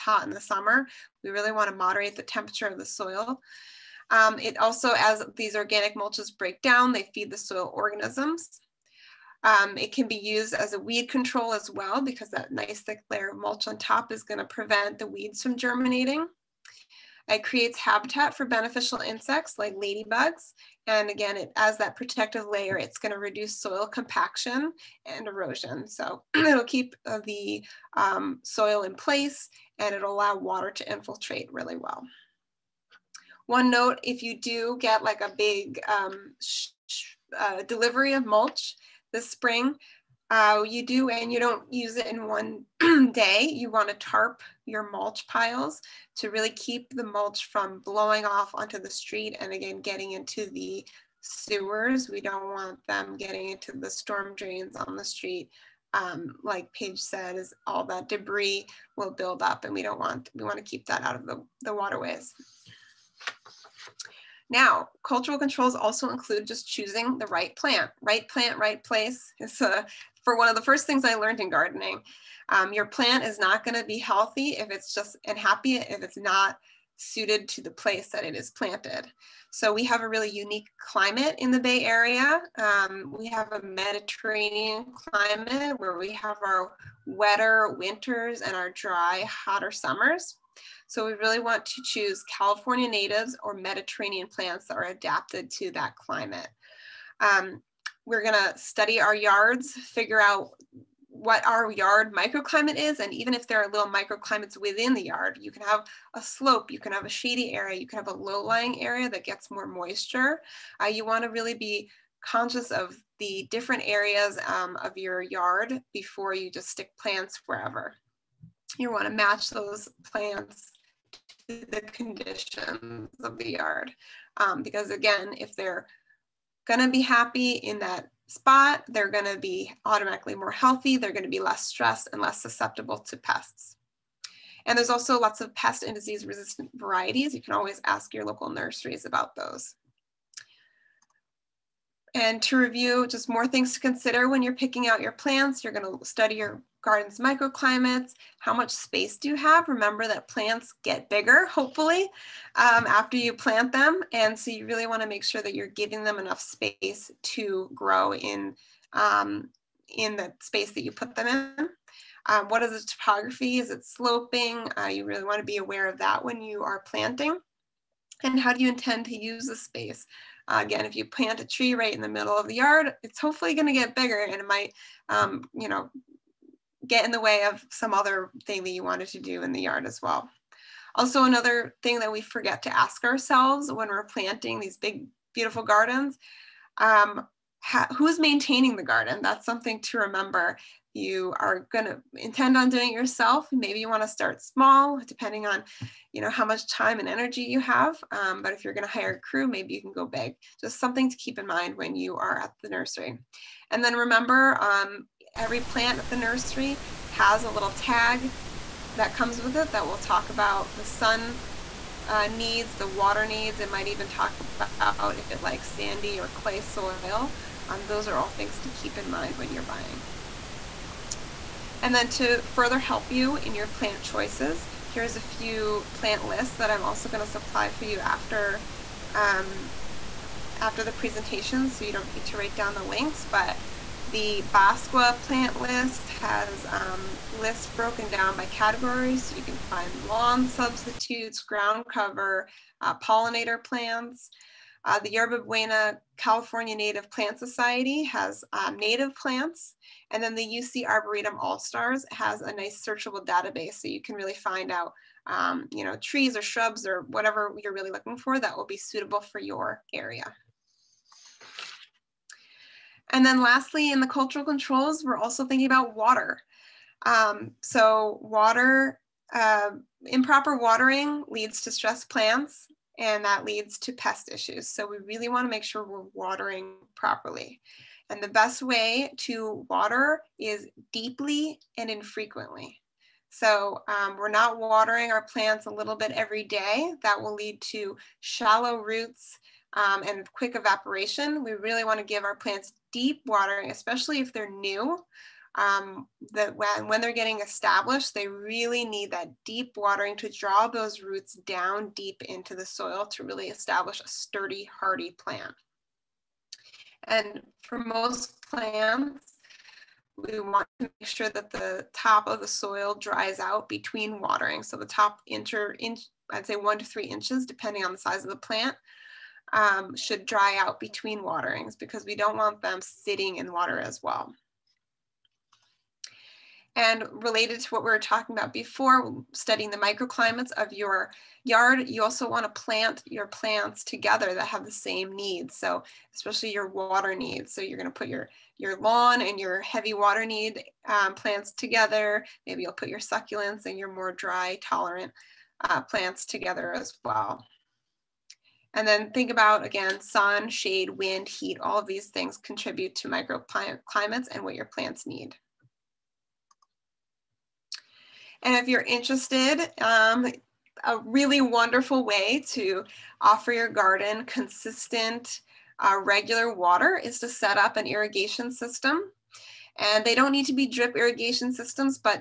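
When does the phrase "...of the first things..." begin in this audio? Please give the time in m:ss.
1:10.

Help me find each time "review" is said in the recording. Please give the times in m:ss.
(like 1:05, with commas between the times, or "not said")
2:22.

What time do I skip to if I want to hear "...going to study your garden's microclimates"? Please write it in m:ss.
2:25.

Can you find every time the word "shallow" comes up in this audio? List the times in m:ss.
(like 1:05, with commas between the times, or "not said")
4:48.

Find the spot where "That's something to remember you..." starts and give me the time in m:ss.
3:09.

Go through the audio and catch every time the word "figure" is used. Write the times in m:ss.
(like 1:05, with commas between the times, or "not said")
1:39.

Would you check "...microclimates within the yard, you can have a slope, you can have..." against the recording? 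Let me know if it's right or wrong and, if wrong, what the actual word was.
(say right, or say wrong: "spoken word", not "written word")
right.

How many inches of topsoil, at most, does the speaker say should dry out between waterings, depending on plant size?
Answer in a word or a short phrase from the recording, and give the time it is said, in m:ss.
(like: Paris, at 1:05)
3, at 5:16.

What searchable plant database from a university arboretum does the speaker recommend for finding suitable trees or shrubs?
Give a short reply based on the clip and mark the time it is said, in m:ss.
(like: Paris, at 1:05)
UC Arboretum All-Stars, at 4:10.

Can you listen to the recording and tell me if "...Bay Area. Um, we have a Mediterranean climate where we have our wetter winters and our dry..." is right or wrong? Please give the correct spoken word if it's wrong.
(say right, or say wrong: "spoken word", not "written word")
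right.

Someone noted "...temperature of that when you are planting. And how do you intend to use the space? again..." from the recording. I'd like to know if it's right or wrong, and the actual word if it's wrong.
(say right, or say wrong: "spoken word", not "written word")
wrong: "aware", not "temperature".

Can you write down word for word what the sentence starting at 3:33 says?
It might even talk about if it likes sandy or clay soil.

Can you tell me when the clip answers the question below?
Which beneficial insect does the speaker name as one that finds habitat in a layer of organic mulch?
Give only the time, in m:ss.
0:19.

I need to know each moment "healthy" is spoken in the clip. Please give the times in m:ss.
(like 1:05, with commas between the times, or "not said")
1:13, 2:10.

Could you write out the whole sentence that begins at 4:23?
And then lastly, in the cultural controls, we're also thinking about water.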